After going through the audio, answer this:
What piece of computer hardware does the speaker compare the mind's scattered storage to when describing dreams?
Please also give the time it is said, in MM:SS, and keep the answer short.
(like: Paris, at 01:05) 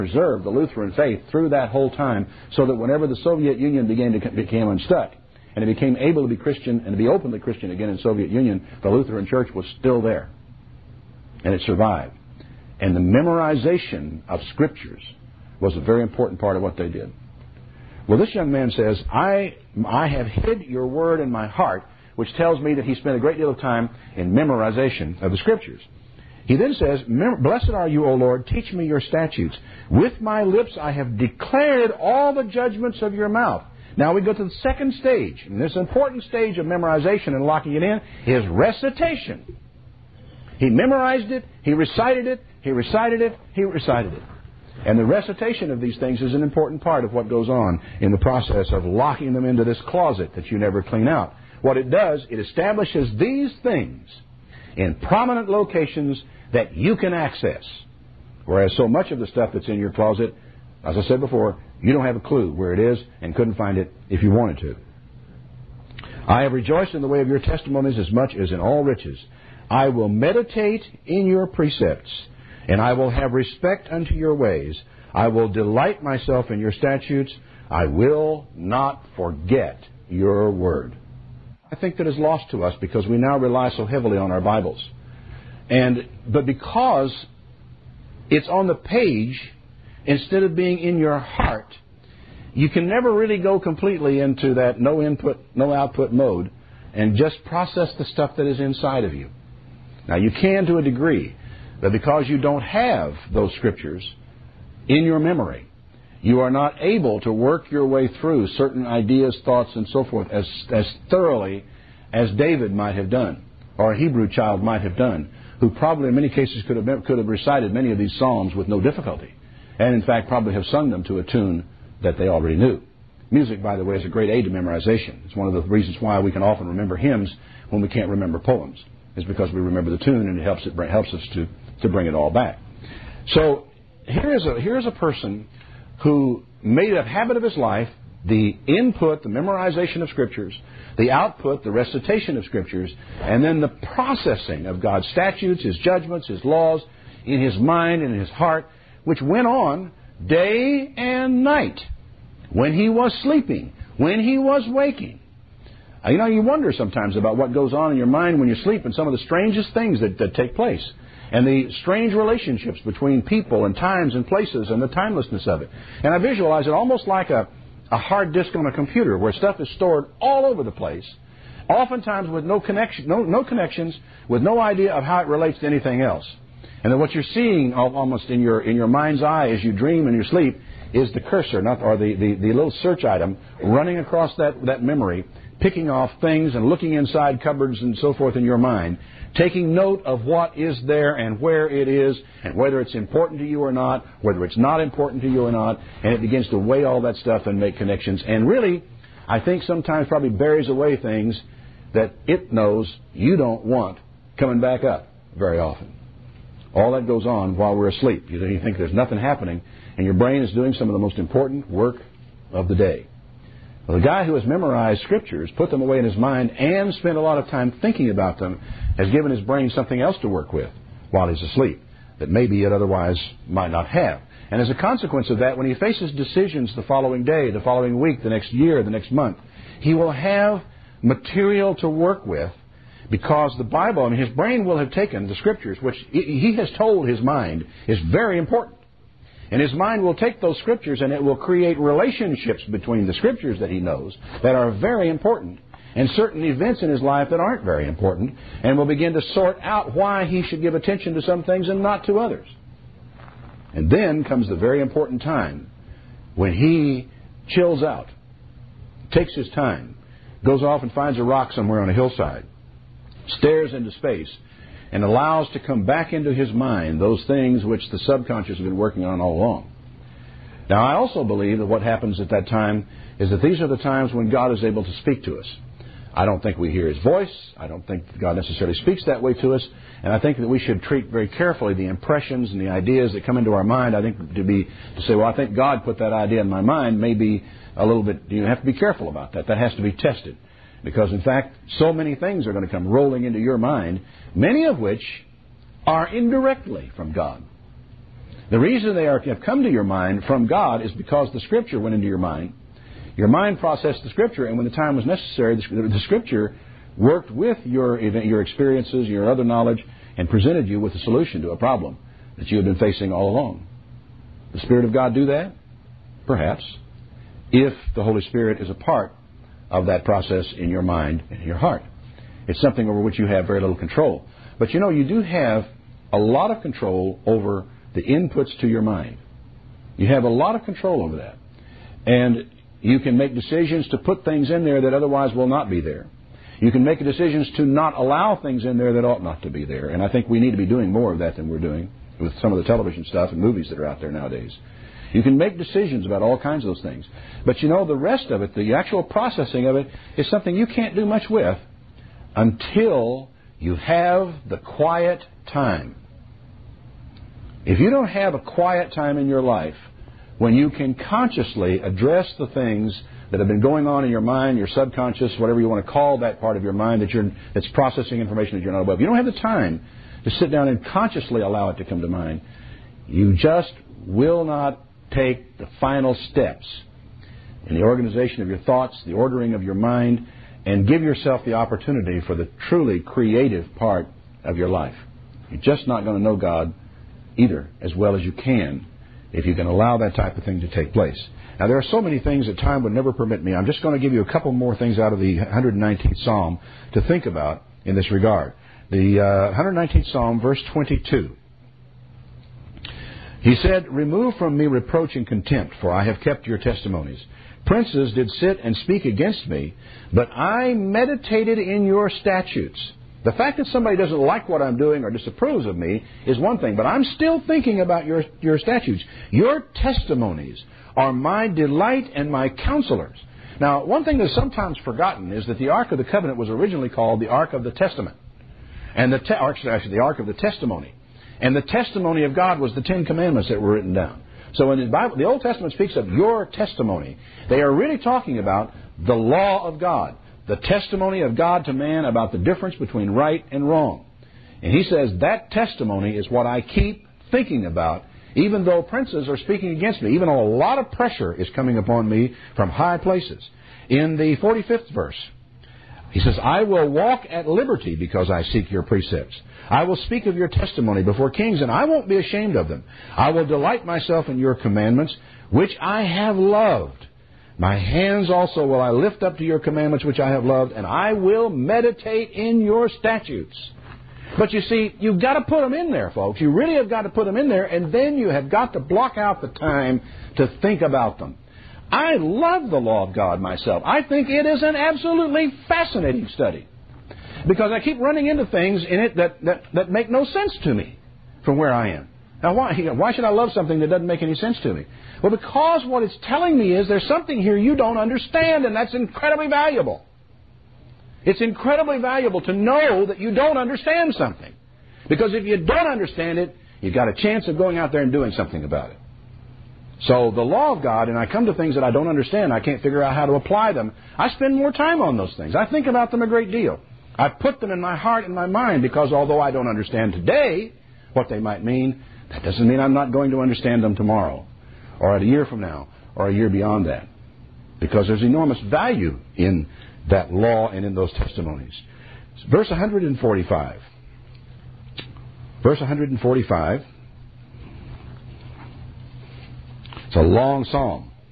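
Hard disk, at 02:47.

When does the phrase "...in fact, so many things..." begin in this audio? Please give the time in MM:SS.
04:51.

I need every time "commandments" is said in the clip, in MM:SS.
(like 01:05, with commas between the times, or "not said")
07:13, 07:44, 07:49.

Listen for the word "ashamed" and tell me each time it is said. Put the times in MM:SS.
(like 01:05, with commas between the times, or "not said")
07:42.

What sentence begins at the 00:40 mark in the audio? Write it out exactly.
He memorized it, he recited it, he recited it, he recited it.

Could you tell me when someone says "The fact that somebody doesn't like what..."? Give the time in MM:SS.
06:53.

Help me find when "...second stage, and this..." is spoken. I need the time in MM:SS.
00:34.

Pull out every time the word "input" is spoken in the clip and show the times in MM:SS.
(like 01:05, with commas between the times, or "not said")
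01:35, 02:18, 05:28.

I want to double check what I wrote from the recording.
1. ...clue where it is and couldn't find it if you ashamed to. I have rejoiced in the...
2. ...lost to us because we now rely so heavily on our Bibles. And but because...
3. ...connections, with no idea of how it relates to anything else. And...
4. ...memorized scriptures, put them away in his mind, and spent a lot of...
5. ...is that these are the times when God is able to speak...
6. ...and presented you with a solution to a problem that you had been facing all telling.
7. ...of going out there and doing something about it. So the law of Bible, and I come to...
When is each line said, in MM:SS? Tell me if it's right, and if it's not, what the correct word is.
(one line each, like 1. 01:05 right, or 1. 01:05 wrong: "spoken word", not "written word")
1. 01:02 wrong: "wanted", not "ashamed"
2. 01:22 right
3. 02:53 right
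4. 03:34 right
5. 04:33 right
6. 05:10 wrong: "along", not "telling"
7. 08:27 wrong: "God", not "Bible".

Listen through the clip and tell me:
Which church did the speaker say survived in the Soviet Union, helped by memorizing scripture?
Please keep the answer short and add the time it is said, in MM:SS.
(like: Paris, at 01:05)
Lutheran Church, at 00:08.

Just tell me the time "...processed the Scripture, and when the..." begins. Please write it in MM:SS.
05:03.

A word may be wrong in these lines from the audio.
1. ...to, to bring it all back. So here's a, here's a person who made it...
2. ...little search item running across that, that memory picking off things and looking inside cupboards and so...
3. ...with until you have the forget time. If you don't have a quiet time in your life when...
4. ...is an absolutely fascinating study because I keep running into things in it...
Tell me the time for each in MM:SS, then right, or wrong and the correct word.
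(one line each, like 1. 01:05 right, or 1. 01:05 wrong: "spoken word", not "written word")
1. 02:11 right
2. 03:02 right
3. 05:51 wrong: "quiet", not "forget"
4. 08:04 right.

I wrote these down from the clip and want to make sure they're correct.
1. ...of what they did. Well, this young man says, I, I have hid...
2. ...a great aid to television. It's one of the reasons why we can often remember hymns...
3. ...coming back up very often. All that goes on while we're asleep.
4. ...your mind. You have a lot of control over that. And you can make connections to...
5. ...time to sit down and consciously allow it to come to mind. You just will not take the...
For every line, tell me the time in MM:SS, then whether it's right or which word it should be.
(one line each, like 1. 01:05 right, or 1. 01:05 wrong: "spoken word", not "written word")
1. 00:16 right
2. 02:04 wrong: "memorization", not "television"
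3. 03:24 right
4. 05:28 wrong: "decisions", not "connections"
5. 06:09 right.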